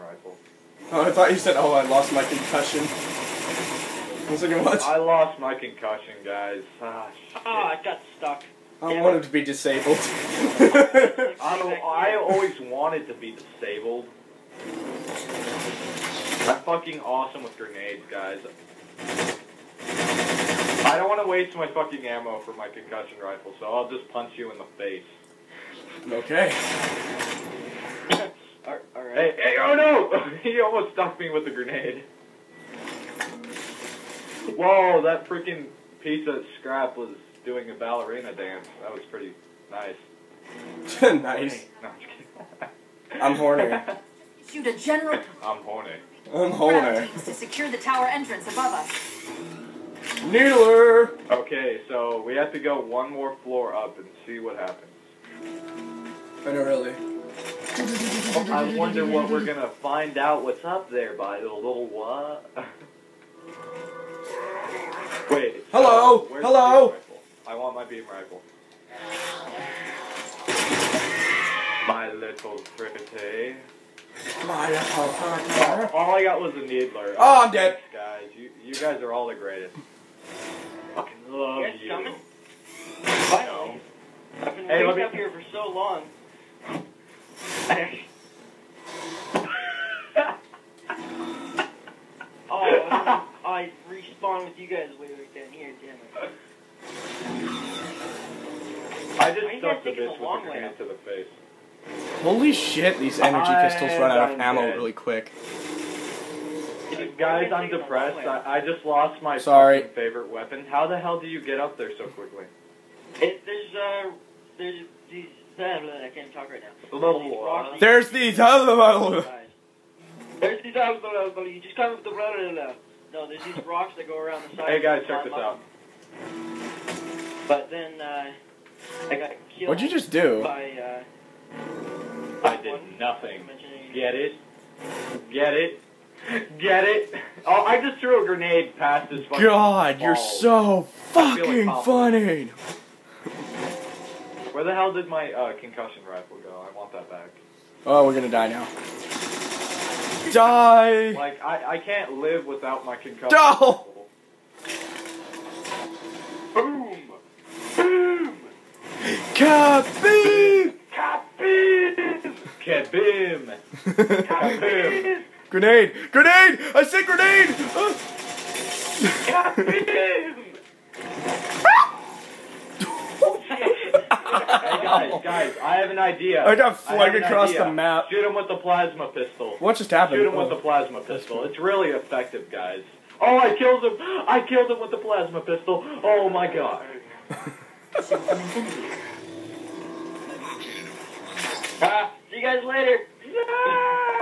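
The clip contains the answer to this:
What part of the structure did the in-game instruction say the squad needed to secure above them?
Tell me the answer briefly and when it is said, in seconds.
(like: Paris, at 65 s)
tower entrance, at 47 s.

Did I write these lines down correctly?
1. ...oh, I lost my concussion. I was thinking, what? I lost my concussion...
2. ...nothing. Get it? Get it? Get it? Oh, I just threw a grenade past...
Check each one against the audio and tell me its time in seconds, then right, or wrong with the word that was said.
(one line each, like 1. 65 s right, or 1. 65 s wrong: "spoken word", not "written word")
1. 1 s right
2. 132 s right.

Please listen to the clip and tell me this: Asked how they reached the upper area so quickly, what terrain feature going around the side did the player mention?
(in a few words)
rocks.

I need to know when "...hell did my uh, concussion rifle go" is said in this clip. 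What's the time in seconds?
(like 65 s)
144 s.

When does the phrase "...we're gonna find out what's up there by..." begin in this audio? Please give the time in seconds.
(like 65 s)
59 s.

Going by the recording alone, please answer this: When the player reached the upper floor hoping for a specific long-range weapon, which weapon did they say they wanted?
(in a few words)
beam rifle.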